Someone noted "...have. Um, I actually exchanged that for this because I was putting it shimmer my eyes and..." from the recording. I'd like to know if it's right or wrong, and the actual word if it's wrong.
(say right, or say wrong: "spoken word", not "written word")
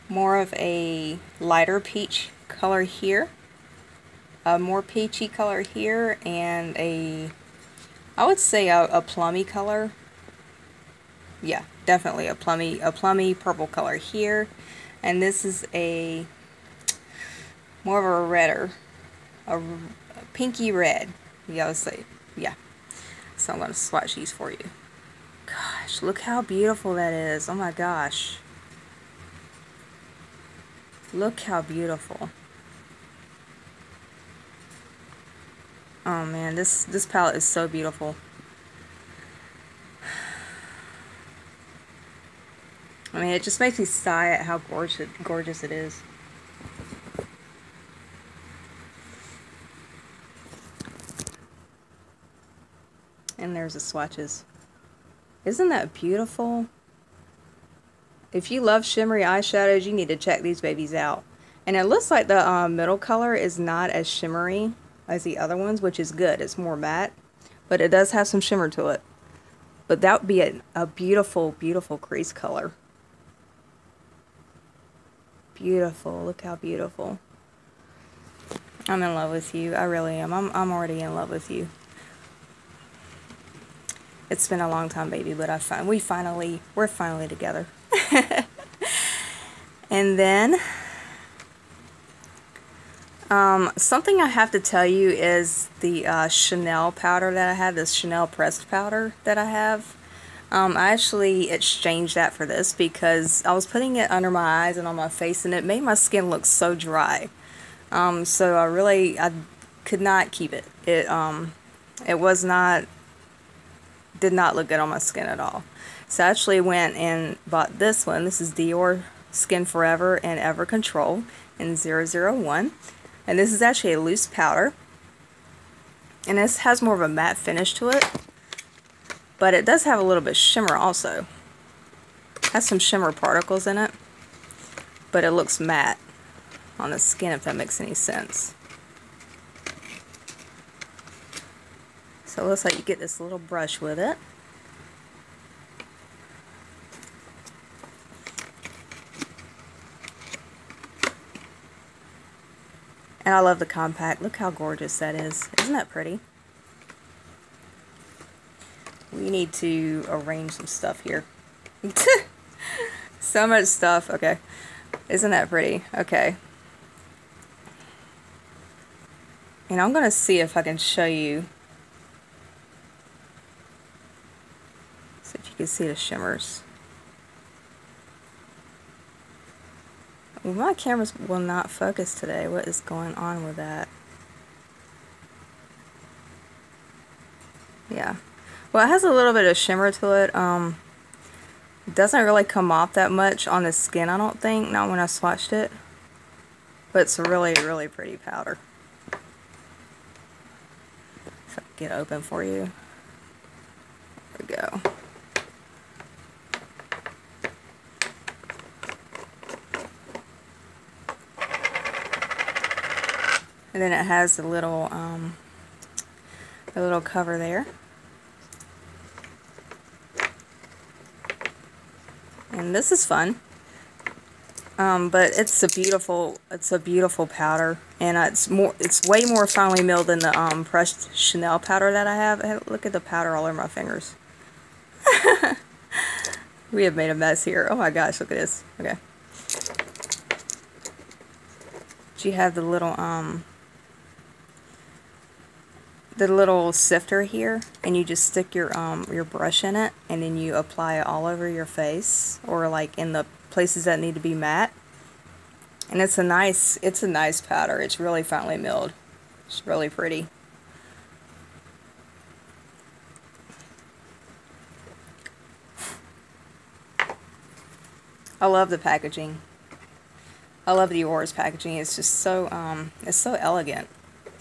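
wrong: "under", not "shimmer".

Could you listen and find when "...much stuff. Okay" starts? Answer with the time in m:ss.
2:43.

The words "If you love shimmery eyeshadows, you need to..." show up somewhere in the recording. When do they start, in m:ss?
0:58.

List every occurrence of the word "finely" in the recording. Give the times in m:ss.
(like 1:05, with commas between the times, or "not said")
3:49, 4:18.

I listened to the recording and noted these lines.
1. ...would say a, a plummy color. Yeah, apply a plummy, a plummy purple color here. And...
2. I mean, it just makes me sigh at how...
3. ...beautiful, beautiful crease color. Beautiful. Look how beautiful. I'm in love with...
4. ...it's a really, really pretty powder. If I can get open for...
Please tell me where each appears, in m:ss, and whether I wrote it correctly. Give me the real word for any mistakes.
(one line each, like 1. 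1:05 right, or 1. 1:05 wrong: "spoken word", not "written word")
1. 0:08 wrong: "definitely", not "apply"
2. 0:43 right
3. 1:10 right
4. 3:17 right.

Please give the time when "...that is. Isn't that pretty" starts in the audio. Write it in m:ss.
2:34.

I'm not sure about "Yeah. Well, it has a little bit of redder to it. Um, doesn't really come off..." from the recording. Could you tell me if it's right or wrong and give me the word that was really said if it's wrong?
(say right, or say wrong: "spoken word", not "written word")
wrong: "shimmer", not "redder".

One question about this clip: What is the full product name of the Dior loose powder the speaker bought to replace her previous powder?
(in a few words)
Dior Skin Forever and Ever Control.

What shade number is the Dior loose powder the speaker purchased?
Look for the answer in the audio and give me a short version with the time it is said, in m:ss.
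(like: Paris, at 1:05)
001, at 2:01.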